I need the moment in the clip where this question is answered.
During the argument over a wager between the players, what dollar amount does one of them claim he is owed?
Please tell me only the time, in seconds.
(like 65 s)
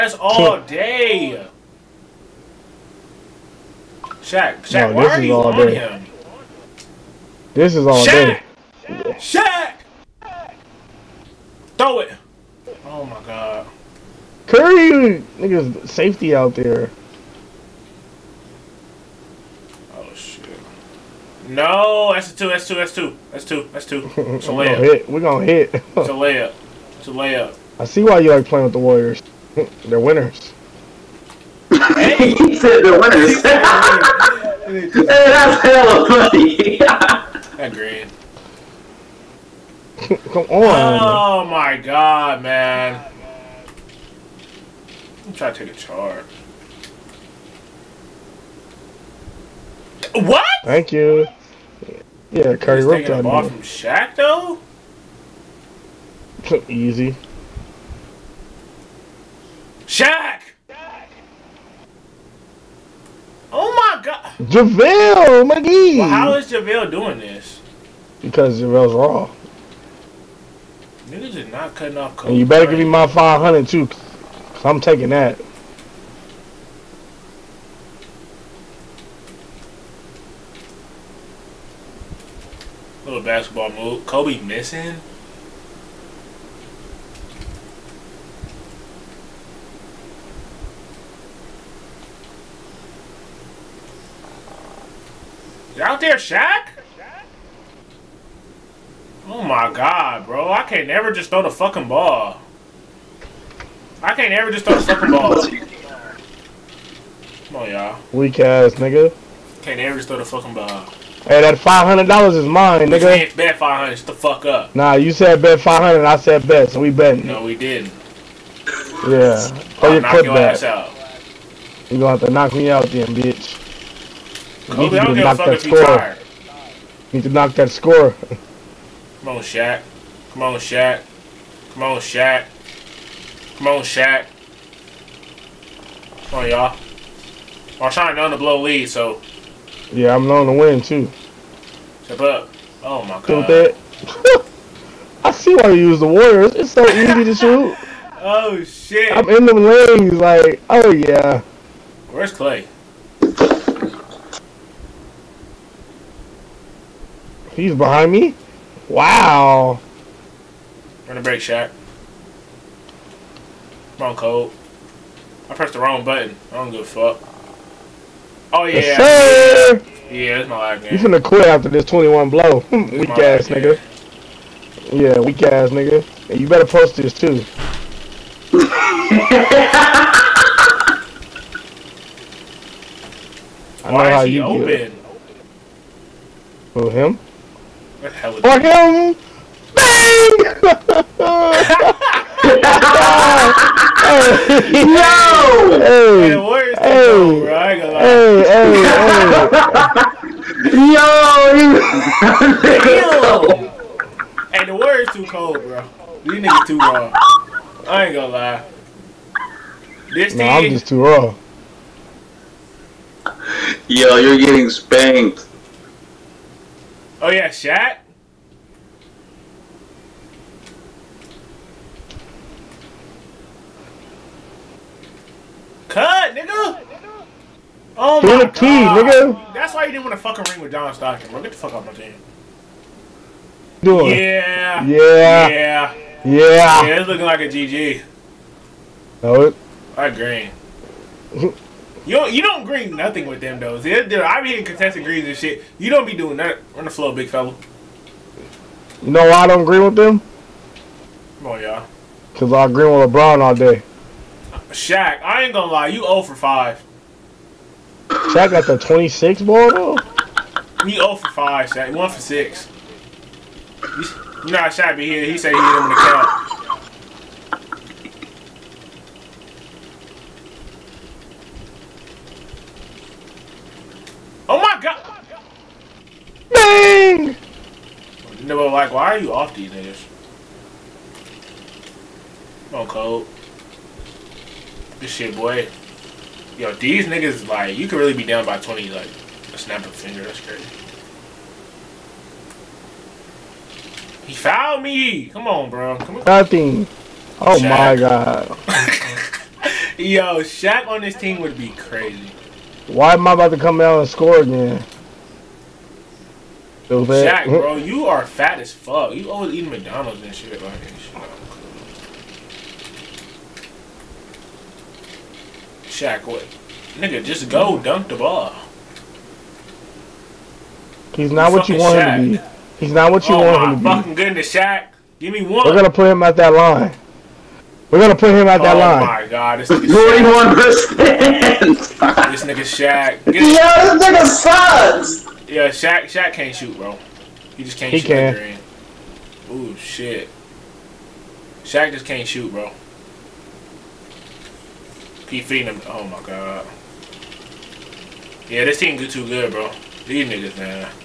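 111 s.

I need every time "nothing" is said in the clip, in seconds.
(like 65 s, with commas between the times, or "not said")
242 s, 296 s.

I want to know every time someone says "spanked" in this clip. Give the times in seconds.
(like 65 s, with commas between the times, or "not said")
214 s.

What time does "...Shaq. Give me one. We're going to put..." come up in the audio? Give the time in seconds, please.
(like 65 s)
324 s.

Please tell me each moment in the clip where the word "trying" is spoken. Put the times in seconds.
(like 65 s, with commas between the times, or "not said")
45 s, 137 s.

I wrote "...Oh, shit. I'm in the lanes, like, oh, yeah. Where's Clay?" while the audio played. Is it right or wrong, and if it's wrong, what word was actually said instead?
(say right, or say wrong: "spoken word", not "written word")
right.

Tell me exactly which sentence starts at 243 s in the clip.
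They're, they're, I be hitting contested greens and shit.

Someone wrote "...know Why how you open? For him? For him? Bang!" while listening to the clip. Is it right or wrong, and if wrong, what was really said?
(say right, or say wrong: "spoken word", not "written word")
right.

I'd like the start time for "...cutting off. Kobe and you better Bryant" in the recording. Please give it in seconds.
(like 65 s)
71 s.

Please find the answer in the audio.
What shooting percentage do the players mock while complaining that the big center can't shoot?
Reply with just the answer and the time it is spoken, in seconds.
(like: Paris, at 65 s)
41%, at 331 s.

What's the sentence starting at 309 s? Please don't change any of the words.
You always eating McDonald's and shit like this.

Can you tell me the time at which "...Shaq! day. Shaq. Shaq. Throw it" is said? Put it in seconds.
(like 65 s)
8 s.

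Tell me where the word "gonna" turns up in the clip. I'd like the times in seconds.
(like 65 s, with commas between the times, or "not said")
25 s, 121 s, 197 s, 208 s, 255 s.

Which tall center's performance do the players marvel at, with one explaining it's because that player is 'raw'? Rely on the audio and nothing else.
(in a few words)
JaVale McGee.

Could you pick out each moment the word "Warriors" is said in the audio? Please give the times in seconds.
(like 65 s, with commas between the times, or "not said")
28 s, 146 s.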